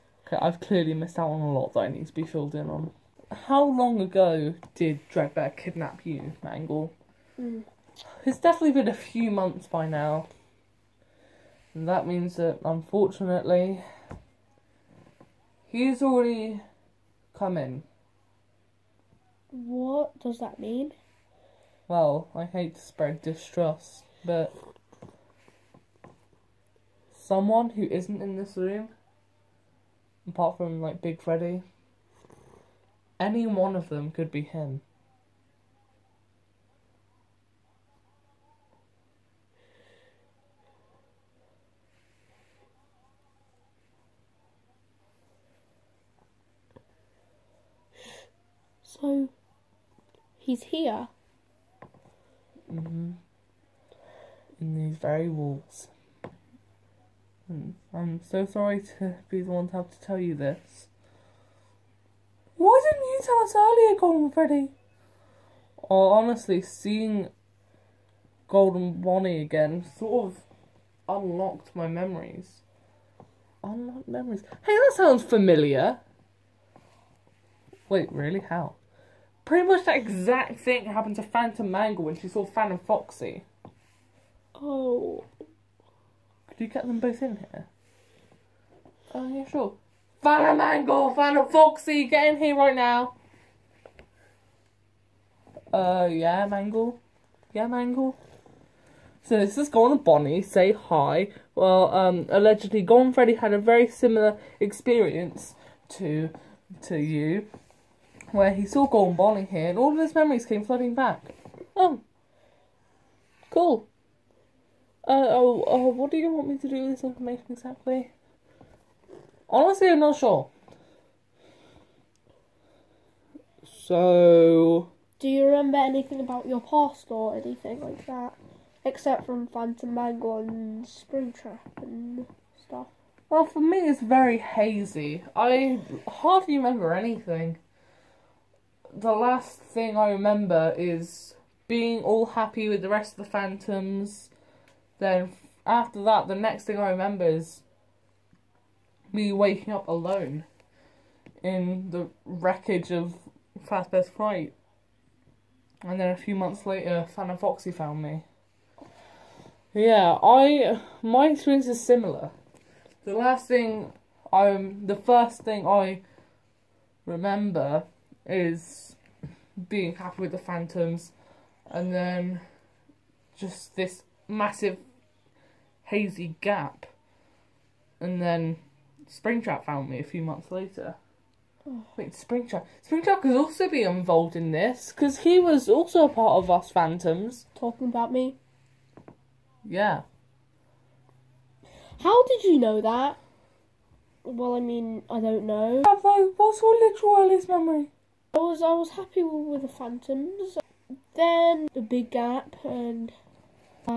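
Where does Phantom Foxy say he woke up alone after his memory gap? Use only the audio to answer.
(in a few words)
the wreckage.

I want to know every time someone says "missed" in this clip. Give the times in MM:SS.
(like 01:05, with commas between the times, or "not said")
00:00.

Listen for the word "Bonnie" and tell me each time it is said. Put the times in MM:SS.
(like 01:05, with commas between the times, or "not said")
01:09, 01:39.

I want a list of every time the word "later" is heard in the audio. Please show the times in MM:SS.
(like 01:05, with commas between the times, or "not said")
02:36, 03:00.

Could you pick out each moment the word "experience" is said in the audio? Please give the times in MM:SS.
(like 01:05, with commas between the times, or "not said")
01:44, 02:41.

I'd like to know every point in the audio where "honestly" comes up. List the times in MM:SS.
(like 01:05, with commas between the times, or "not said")
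01:06, 01:59.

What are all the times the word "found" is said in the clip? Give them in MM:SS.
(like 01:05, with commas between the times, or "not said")
02:37, 02:59.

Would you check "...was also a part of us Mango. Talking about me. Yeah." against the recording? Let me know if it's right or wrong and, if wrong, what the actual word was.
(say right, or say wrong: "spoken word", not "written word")
wrong: "Phantoms", not "Mango".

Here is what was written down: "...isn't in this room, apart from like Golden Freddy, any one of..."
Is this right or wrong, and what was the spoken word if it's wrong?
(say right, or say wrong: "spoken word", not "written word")
wrong: "Big", not "Golden".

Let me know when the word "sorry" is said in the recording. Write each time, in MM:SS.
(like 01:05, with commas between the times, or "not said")
00:58.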